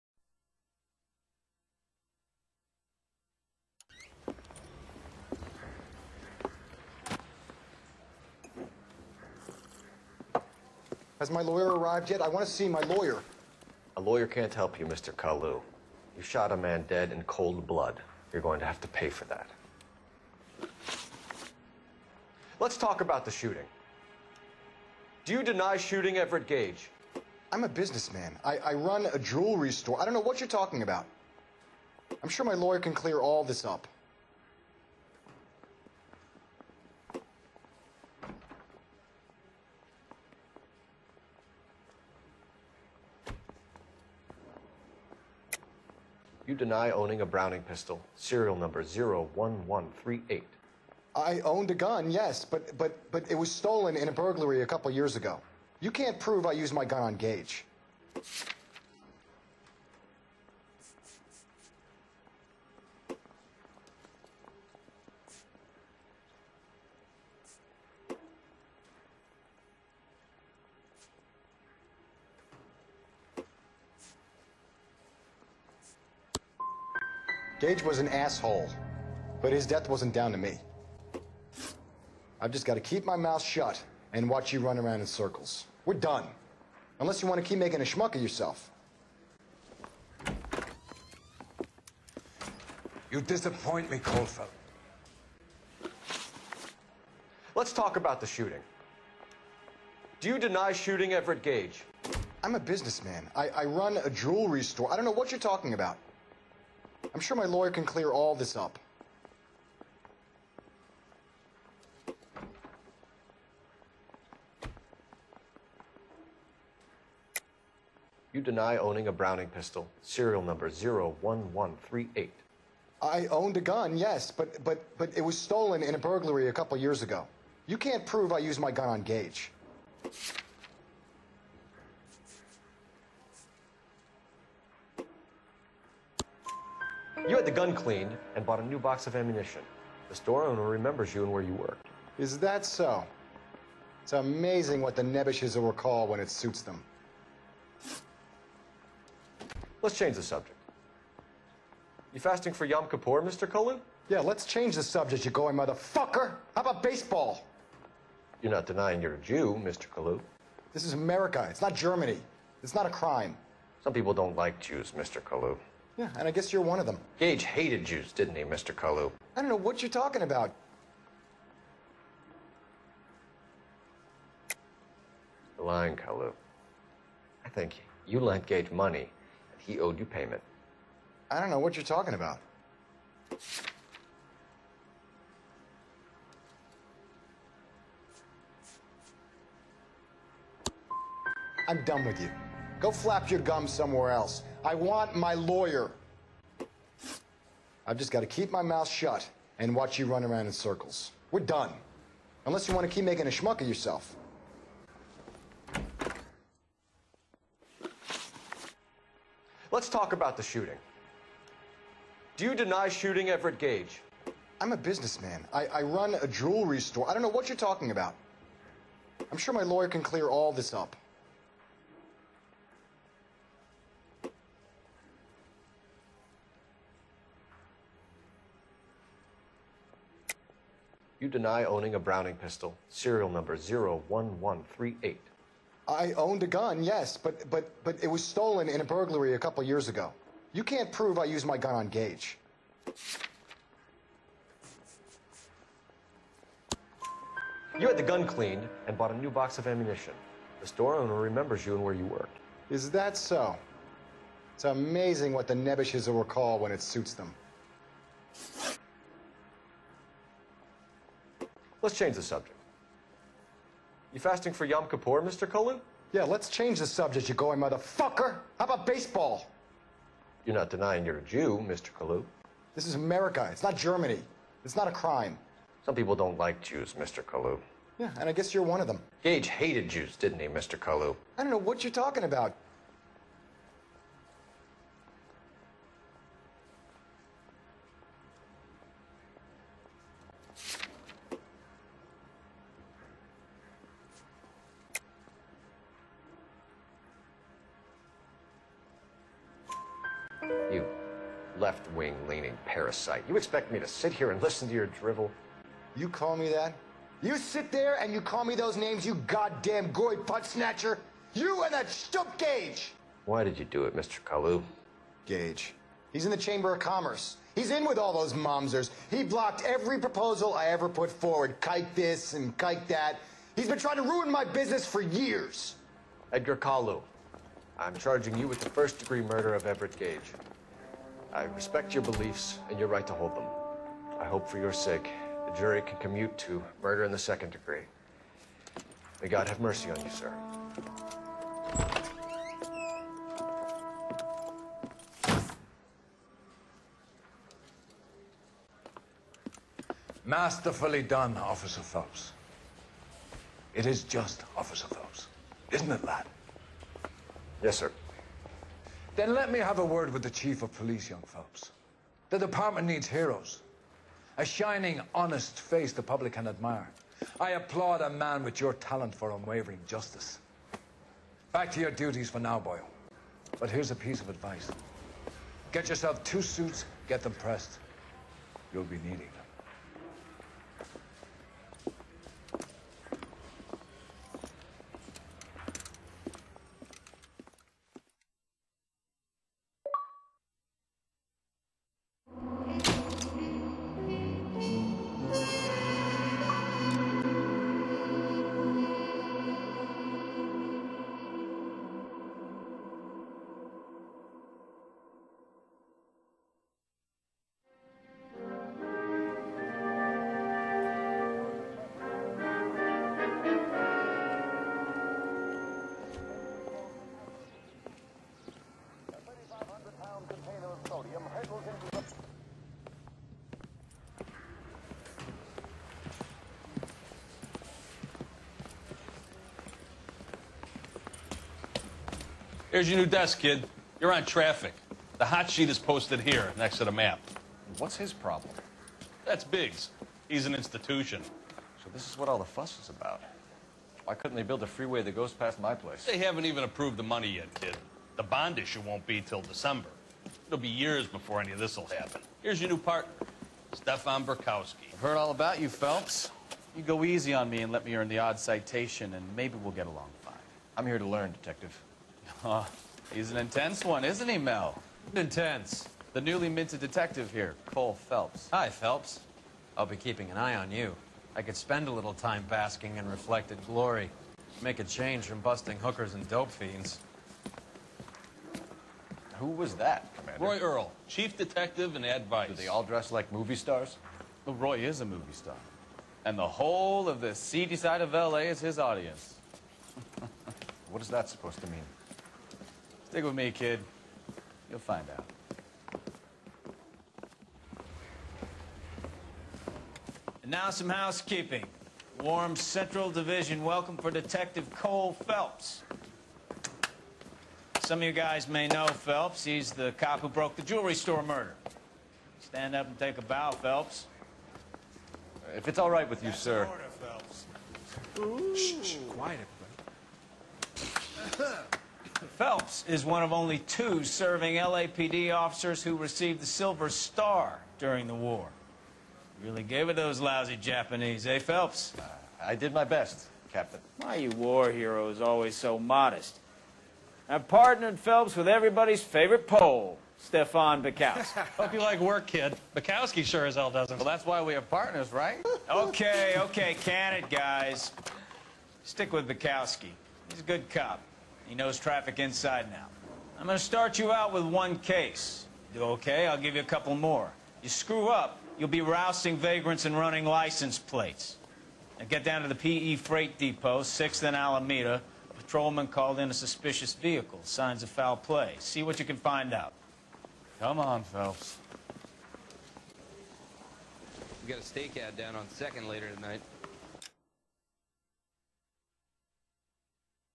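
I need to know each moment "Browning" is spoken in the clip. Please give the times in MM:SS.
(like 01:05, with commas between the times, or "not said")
00:47, 01:59, 03:51.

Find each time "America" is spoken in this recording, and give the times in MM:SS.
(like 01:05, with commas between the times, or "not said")
02:40, 04:32.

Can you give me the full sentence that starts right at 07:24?
Why couldn't they build a freeway that goes past my place?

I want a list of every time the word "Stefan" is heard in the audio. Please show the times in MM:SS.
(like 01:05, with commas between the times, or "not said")
07:33, 09:00.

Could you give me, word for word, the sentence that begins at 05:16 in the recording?
He's in the Chamber of Commerce.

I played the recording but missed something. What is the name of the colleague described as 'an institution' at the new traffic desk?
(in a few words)
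Biggs.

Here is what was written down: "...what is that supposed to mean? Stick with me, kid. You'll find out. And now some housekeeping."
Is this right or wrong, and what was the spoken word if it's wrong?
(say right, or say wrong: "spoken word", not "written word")
right.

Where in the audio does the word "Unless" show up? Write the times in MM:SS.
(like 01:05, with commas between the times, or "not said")
01:26, 03:22.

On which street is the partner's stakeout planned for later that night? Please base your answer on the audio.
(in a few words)
2nd.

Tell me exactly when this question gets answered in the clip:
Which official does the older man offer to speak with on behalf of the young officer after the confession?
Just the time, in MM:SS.
06:00.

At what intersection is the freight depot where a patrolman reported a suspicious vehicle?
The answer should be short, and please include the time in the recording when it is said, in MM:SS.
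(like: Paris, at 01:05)
6th and Alameda, at 09:23.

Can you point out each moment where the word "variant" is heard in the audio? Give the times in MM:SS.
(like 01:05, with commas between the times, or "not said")
not said.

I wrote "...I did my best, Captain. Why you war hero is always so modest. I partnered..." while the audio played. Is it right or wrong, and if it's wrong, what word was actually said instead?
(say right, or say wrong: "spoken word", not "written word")
right.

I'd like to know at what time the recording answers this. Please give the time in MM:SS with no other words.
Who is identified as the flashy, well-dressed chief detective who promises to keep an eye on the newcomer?
08:00.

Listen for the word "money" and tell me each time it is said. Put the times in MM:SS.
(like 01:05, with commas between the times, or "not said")
02:58, 07:27.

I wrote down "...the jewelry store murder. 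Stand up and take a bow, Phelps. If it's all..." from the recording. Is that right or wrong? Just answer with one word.
right.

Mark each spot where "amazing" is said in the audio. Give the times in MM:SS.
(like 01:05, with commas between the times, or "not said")
02:24, 04:14.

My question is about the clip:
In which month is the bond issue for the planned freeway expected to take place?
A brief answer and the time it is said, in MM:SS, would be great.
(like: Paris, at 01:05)
December, at 07:29.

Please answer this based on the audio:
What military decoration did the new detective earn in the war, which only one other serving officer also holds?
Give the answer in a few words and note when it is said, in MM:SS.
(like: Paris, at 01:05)
Silver Star, at 08:46.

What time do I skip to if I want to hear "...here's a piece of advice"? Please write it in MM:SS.
06:13.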